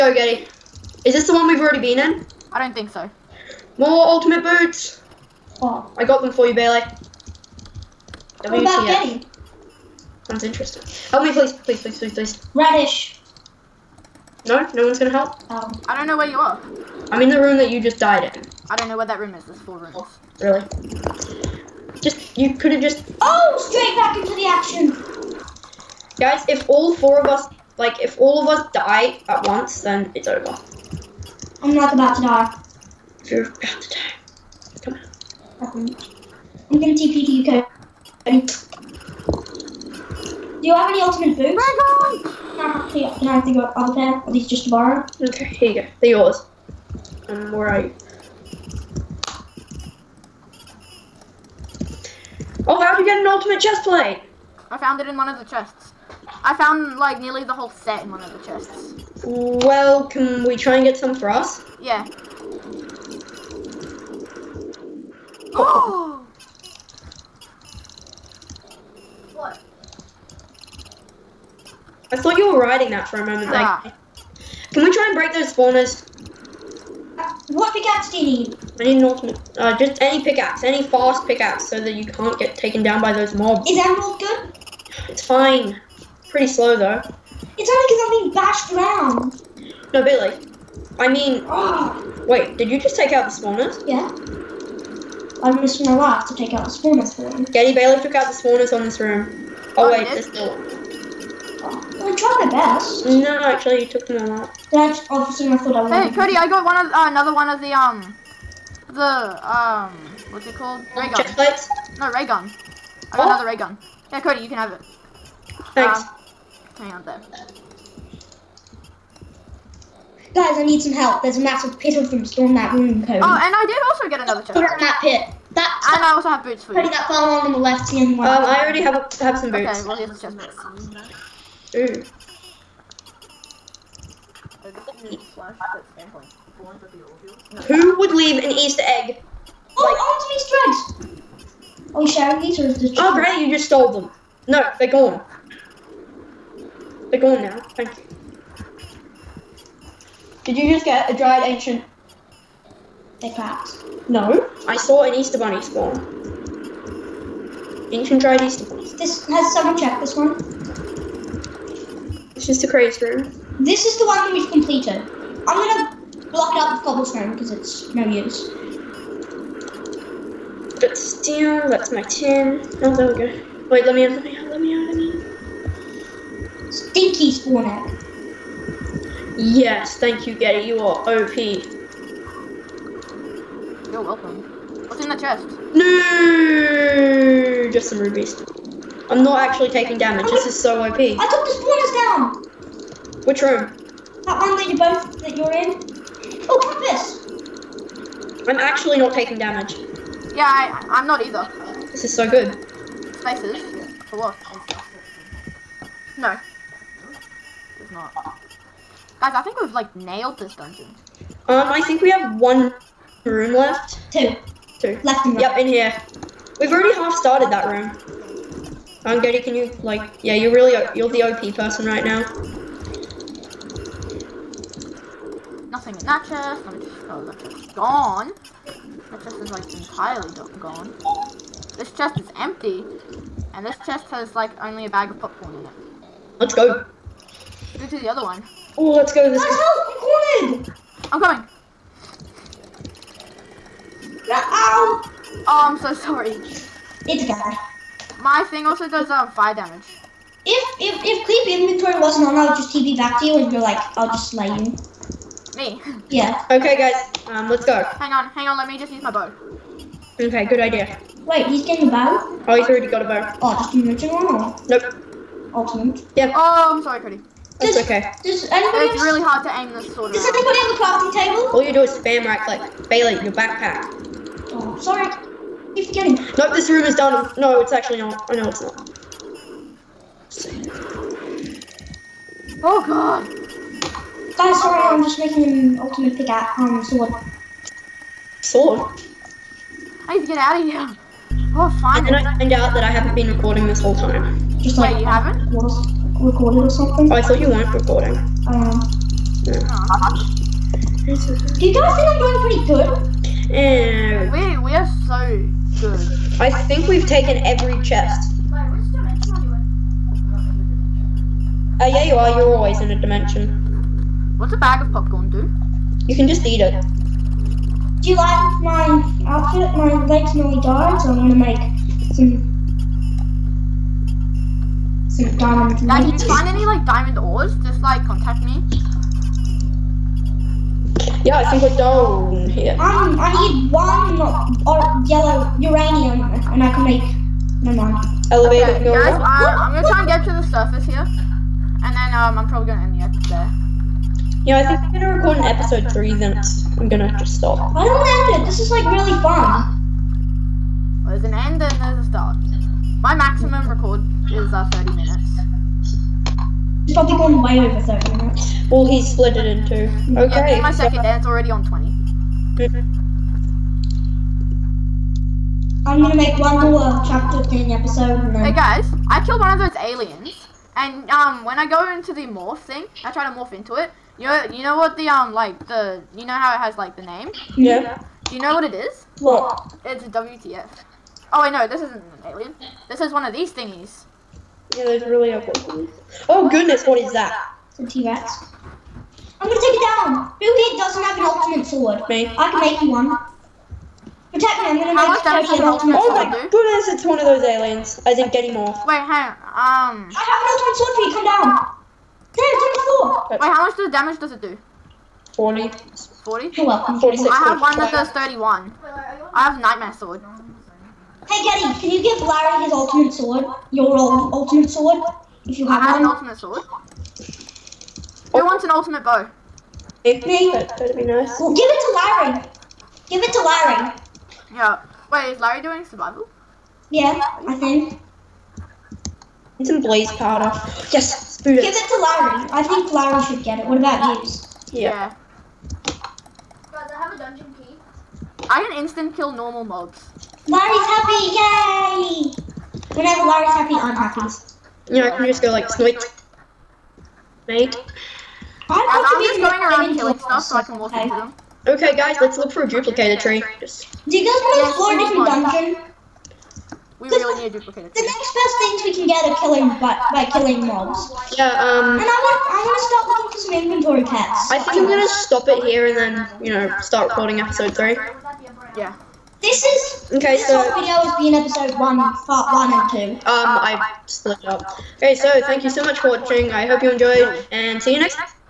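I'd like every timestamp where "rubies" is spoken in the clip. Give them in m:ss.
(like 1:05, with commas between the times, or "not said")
3:07.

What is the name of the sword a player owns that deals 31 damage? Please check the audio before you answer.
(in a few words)
Nightmare Sword.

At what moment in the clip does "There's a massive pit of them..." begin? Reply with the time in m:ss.
2:01.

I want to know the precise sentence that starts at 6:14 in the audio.
You know, you know what the um like the you know how it has like the name?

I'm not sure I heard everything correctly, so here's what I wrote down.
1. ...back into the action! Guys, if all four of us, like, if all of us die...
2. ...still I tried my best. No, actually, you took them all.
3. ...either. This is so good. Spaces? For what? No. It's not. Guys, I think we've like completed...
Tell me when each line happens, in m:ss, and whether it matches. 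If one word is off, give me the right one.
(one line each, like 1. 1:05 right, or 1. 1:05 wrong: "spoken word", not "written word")
1. 0:23 right
2. 1:40 right
3. 3:21 wrong: "nailed", not "completed".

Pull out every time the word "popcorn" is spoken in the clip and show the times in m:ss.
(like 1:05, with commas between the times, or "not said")
3:55, 5:14.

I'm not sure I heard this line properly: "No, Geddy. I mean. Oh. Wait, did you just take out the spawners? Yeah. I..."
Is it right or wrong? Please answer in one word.
wrong.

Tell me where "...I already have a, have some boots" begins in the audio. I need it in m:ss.
2:08.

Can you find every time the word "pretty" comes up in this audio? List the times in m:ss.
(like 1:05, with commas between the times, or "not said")
1:26, 5:02.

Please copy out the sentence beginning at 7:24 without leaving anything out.
Yeah, I can just go like snoit.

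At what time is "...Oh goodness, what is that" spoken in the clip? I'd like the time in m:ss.
6:26.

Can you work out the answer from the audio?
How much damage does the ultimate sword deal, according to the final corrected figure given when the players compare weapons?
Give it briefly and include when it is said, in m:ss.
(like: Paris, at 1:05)
46, at 6:46.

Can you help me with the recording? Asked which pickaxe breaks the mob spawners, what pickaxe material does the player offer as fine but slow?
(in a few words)
Emerald.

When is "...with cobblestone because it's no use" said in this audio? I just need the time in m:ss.
2:46.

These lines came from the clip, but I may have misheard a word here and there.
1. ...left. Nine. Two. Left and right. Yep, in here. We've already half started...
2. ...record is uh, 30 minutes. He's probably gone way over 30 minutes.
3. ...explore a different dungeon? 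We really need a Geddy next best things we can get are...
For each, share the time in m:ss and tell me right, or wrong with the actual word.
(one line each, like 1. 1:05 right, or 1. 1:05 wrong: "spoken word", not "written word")
1. 3:33 wrong: "Two", not "Nine"
2. 5:53 right
3. 7:34 wrong: "The", not "Geddy".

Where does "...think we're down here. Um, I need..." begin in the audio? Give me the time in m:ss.
5:31.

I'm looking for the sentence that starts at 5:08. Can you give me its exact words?
Wait, which dimension are you in?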